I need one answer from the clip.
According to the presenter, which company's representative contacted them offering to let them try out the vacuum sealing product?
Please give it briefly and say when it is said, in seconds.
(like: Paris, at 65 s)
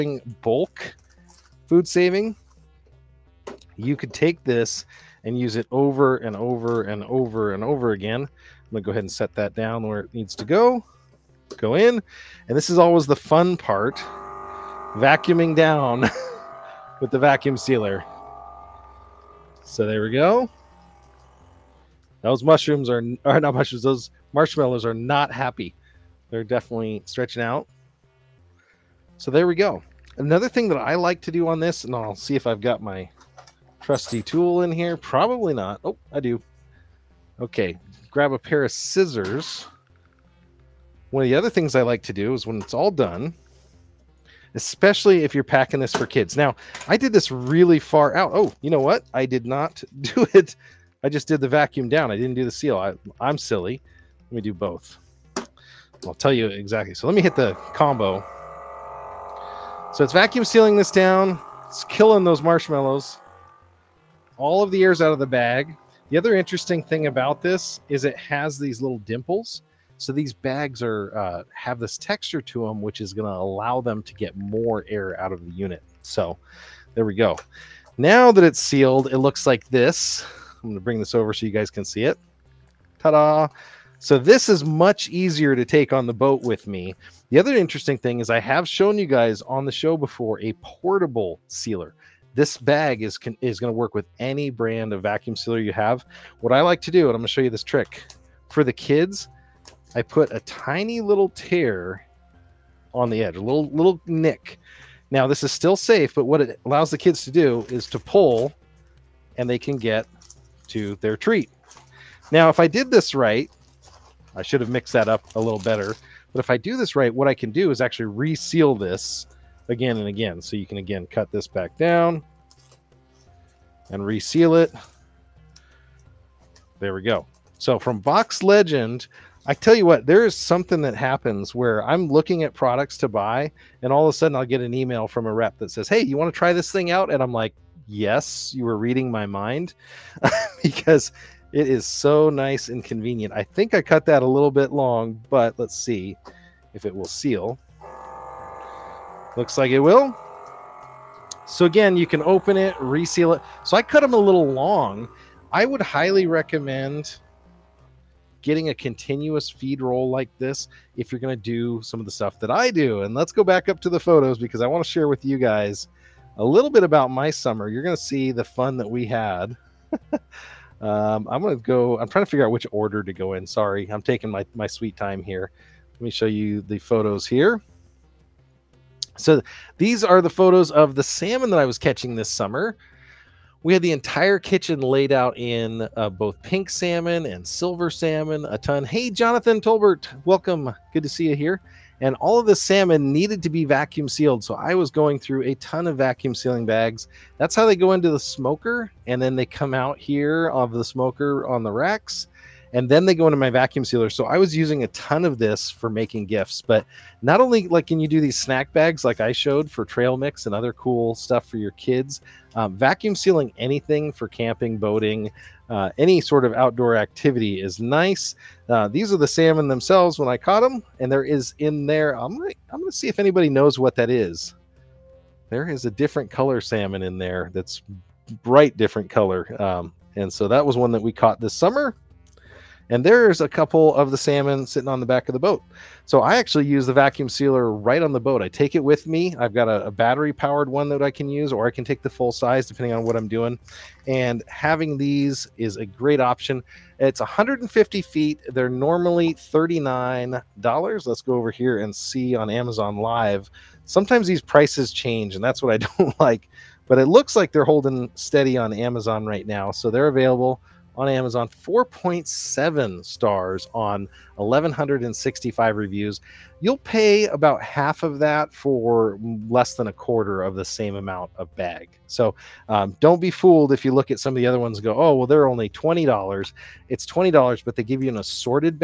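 Box Legend, at 127 s.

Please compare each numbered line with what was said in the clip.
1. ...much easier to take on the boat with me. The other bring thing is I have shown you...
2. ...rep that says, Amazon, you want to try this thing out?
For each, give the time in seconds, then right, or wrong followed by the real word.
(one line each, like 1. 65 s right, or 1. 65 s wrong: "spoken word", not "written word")
1. 84 s wrong: "interesting", not "bring"
2. 135 s wrong: "Hey", not "Amazon".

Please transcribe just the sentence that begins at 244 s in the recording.
And having these is a great option.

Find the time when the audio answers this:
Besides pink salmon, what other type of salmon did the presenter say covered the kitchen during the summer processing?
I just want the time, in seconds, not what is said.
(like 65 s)
187 s.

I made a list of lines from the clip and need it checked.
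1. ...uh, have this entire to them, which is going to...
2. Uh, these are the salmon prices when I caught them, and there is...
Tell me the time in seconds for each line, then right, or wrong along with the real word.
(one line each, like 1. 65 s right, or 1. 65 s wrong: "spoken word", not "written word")
1. 71 s wrong: "texture", not "entire"
2. 218 s wrong: "themselves", not "prices".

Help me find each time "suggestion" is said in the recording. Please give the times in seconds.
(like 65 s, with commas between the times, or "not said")
not said.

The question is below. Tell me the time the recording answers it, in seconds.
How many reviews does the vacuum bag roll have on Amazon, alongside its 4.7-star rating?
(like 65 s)
264 s.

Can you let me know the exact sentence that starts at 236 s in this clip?
So I actually use the vacuum sealer right on the boat.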